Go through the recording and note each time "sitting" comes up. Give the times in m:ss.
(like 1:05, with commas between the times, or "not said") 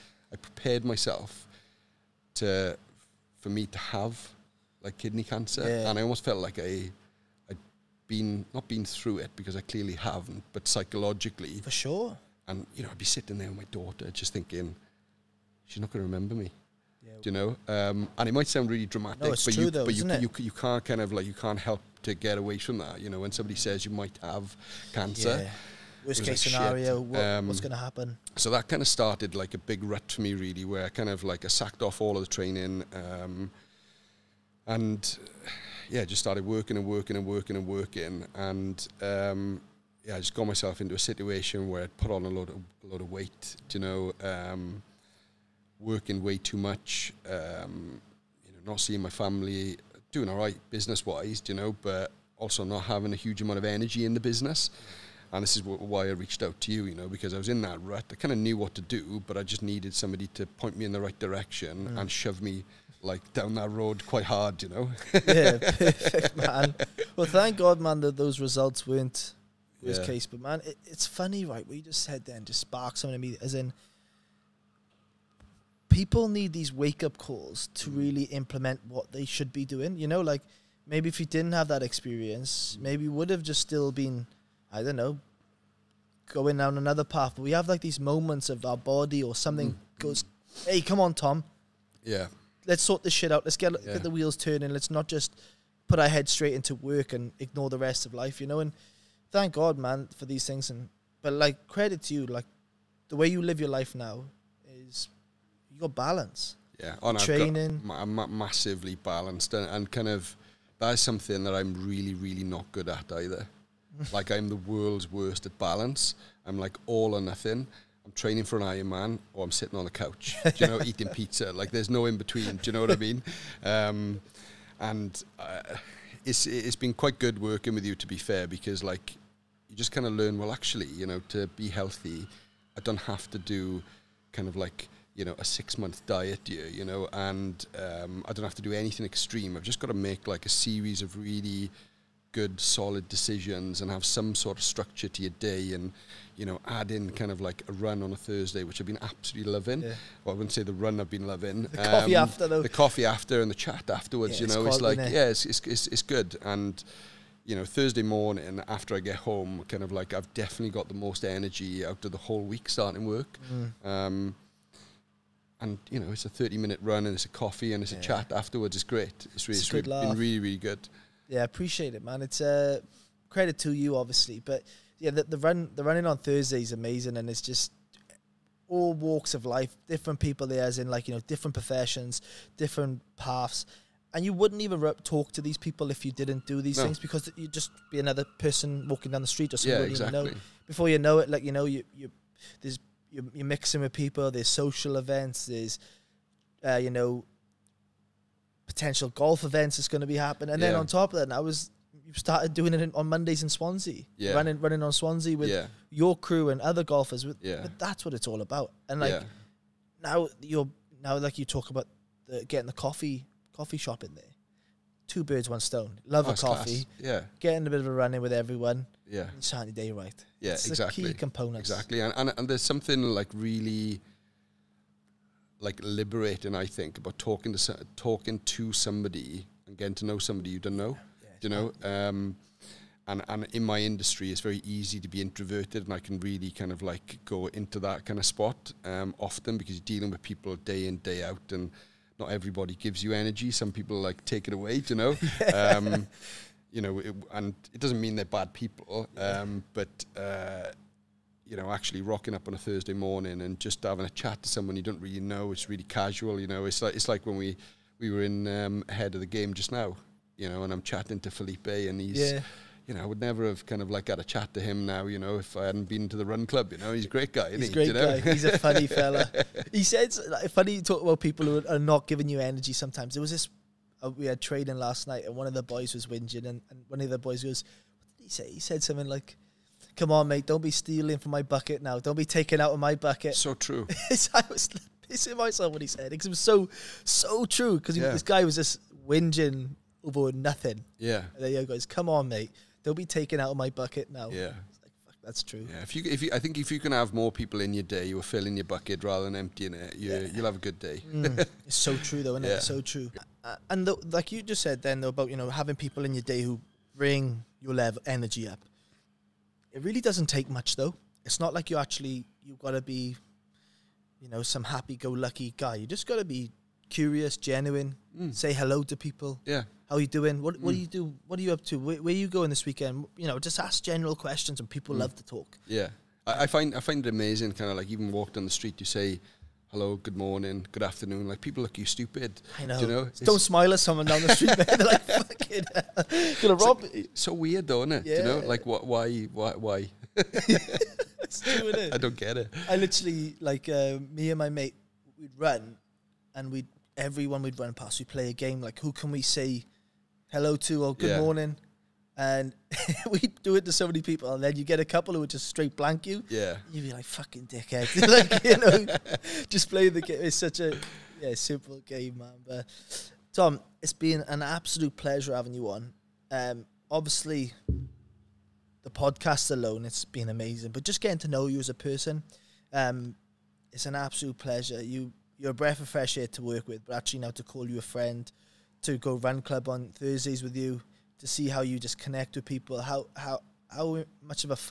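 0:13, 1:59.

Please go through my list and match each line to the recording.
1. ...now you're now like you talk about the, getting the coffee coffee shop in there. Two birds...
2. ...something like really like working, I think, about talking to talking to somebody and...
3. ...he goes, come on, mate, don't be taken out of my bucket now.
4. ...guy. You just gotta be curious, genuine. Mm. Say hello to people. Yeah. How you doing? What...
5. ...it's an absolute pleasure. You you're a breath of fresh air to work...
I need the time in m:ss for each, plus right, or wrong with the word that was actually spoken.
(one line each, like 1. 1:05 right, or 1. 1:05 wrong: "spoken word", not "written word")
1. 3:30 right
2. 3:42 wrong: "liberating", not "working"
3. 4:51 right
4. 5:15 right
5. 6:13 right.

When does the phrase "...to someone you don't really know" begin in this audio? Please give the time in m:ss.
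4:14.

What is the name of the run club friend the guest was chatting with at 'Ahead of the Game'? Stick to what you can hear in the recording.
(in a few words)
Felipe.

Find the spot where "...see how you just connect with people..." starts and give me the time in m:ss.
6:21.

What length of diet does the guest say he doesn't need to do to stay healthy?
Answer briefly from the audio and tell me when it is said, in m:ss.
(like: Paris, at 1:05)
6 month, at 2:15.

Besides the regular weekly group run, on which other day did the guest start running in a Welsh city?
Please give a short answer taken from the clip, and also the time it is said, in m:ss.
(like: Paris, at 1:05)
Mondays, at 3:23.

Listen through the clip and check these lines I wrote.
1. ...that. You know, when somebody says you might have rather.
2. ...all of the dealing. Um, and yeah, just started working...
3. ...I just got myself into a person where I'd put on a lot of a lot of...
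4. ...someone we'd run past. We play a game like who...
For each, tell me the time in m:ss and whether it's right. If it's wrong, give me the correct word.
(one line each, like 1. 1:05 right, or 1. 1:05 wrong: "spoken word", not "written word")
1. 0:22 wrong: "cancer", not "rather"
2. 0:32 wrong: "training", not "dealing"
3. 0:40 wrong: "situation", not "person"
4. 5:46 wrong: "everyone", not "someone".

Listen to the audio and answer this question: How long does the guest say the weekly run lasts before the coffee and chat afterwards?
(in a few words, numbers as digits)
30 minutes.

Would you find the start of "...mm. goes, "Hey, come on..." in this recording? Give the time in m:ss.
1:29.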